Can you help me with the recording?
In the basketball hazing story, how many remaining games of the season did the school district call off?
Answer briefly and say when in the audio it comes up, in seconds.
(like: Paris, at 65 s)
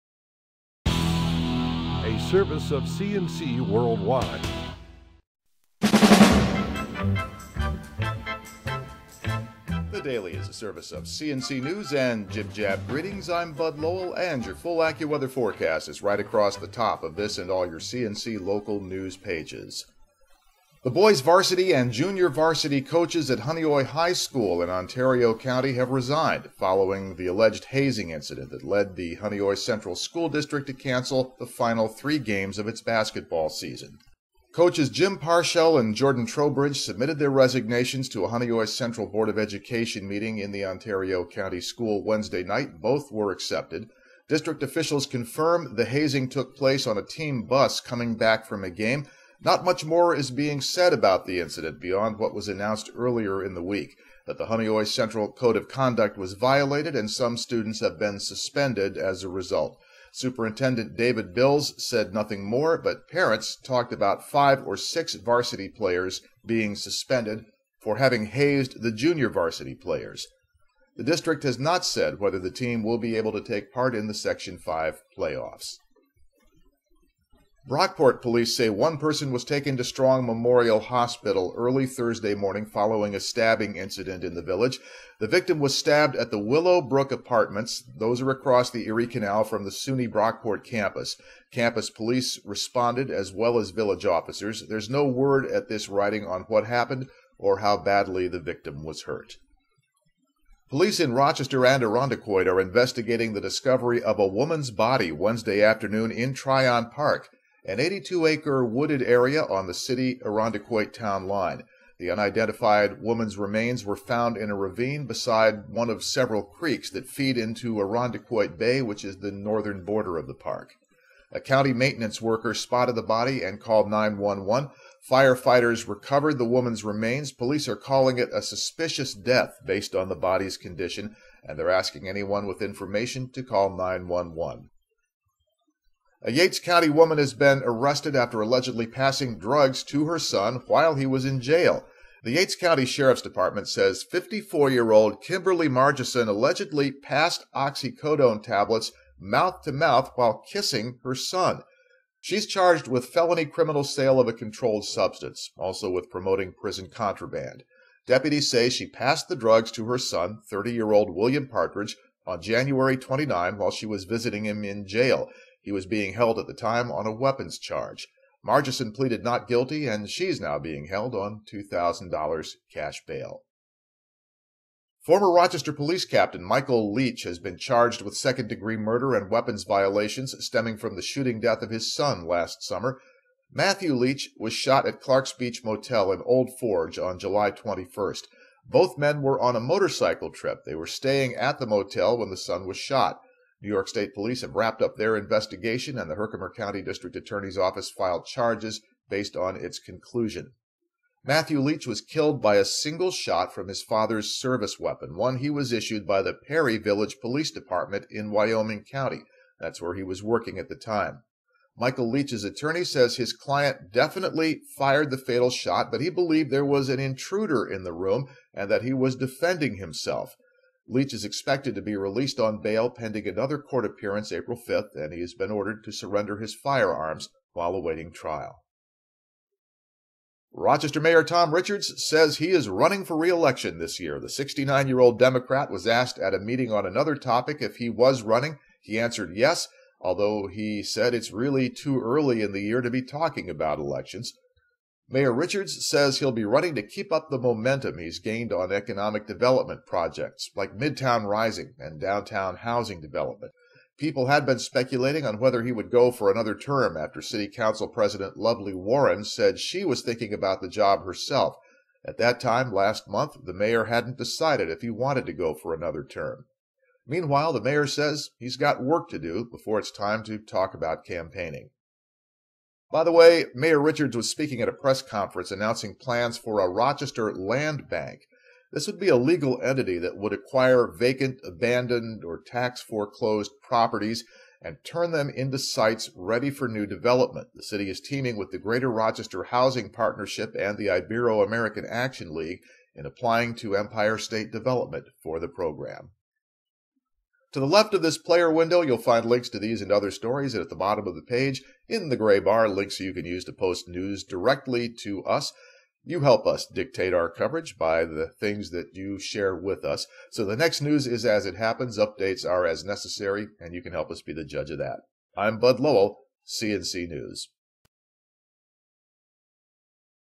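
3, at 31 s.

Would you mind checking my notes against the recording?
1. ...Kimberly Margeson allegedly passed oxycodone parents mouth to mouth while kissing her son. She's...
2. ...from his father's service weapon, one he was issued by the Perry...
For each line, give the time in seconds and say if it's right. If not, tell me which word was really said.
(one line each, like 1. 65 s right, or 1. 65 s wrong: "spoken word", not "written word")
1. 145 s wrong: "tablets", not "parents"
2. 203 s right.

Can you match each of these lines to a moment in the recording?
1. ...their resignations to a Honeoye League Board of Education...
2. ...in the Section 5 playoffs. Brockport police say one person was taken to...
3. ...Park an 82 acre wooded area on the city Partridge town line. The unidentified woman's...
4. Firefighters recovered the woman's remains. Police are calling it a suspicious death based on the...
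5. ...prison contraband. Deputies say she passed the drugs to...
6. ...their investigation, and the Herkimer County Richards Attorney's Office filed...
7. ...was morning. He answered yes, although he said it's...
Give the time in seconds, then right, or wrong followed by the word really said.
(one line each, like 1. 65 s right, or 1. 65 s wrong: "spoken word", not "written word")
1. 37 s wrong: "Central", not "League"
2. 73 s right
3. 106 s wrong: "Irondequoit", not "Partridge"
4. 125 s right
5. 156 s right
6. 194 s wrong: "District", not "Richards"
7. 237 s wrong: "running", not "morning".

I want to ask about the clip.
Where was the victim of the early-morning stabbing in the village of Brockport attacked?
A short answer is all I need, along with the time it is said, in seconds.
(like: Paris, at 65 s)
Willow Brook Apartments, at 86 s.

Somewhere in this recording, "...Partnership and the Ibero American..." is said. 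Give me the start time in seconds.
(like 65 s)
289 s.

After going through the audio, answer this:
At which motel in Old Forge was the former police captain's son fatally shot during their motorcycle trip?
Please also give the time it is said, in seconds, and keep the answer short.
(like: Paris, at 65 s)
Clark's Beach Motel, at 185 s.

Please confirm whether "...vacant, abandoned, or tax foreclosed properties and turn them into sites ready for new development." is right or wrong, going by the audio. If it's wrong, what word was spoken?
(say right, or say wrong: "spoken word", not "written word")
right.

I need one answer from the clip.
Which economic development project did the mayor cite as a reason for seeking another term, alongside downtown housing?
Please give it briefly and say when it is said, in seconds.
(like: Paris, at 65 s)
Midtown Rising, at 250 s.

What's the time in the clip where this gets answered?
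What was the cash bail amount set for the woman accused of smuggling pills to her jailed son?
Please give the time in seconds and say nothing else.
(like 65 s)
171 s.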